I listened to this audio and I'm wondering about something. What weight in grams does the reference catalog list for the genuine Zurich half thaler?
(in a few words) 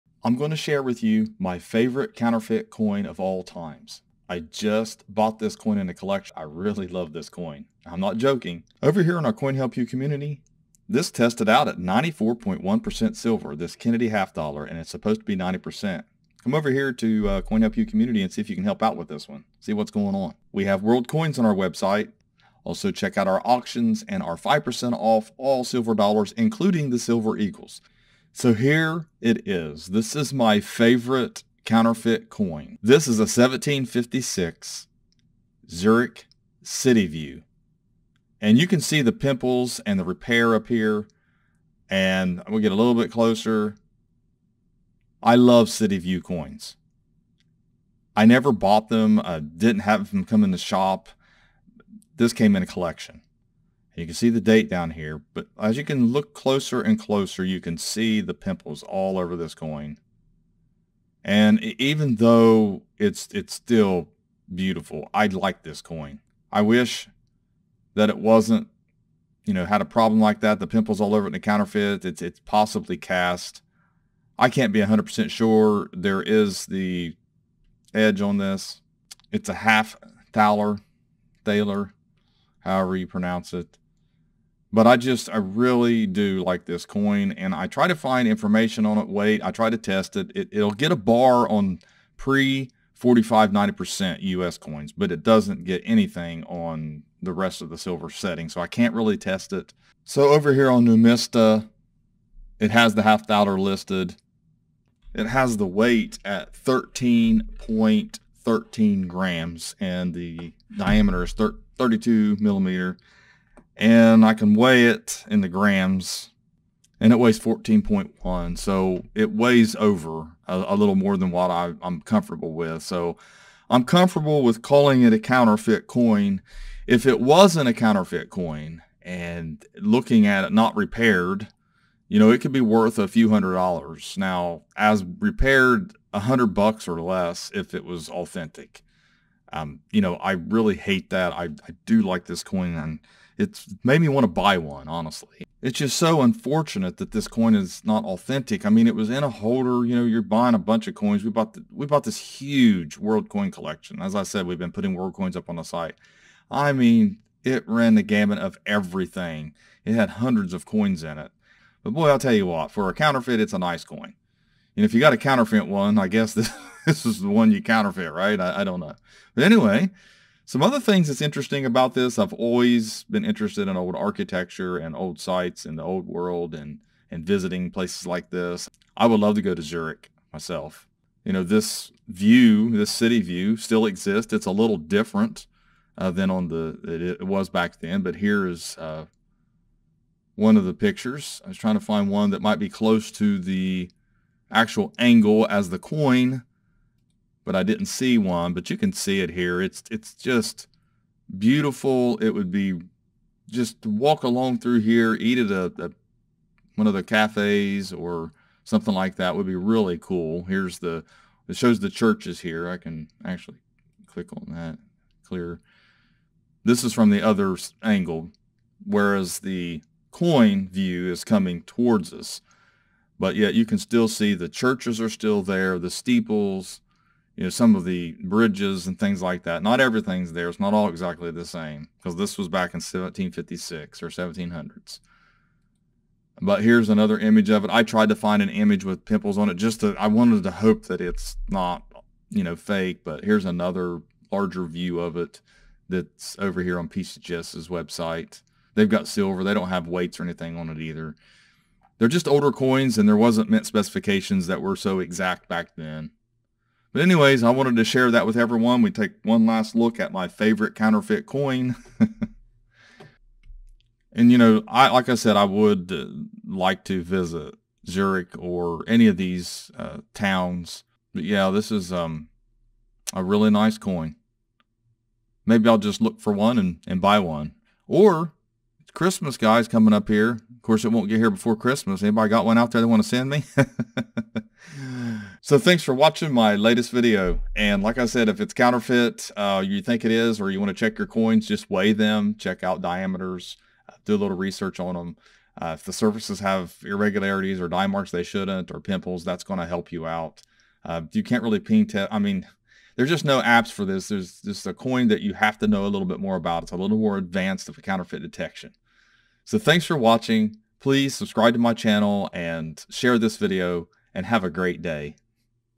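13.13 grams.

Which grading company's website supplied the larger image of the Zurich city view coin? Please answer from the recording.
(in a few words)
PCGS.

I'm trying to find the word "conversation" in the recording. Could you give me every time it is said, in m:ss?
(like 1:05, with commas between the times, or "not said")
not said.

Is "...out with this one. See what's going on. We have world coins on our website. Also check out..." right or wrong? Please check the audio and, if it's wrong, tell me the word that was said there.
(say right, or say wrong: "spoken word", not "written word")
right.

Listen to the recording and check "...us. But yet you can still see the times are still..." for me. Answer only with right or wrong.
wrong.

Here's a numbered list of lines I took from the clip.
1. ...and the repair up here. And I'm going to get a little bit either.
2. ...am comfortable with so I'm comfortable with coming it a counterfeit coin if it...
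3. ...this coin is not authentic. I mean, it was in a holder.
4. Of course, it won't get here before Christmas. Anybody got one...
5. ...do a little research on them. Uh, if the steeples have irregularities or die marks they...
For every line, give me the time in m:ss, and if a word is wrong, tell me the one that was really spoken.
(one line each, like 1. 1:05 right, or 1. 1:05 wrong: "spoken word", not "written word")
1. 0:39 wrong: "closer", not "either"
2. 2:01 wrong: "calling", not "coming"
3. 2:27 right
4. 4:40 right
5. 4:54 wrong: "surfaces", not "steeples".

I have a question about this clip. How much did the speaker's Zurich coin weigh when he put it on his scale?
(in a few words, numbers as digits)
14.1 grams.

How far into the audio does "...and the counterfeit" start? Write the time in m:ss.
1:11.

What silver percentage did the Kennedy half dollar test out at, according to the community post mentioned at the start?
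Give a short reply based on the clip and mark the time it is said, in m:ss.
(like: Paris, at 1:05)
94.1%, at 0:11.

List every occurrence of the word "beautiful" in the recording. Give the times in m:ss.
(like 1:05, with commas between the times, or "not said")
1:04, 3:21.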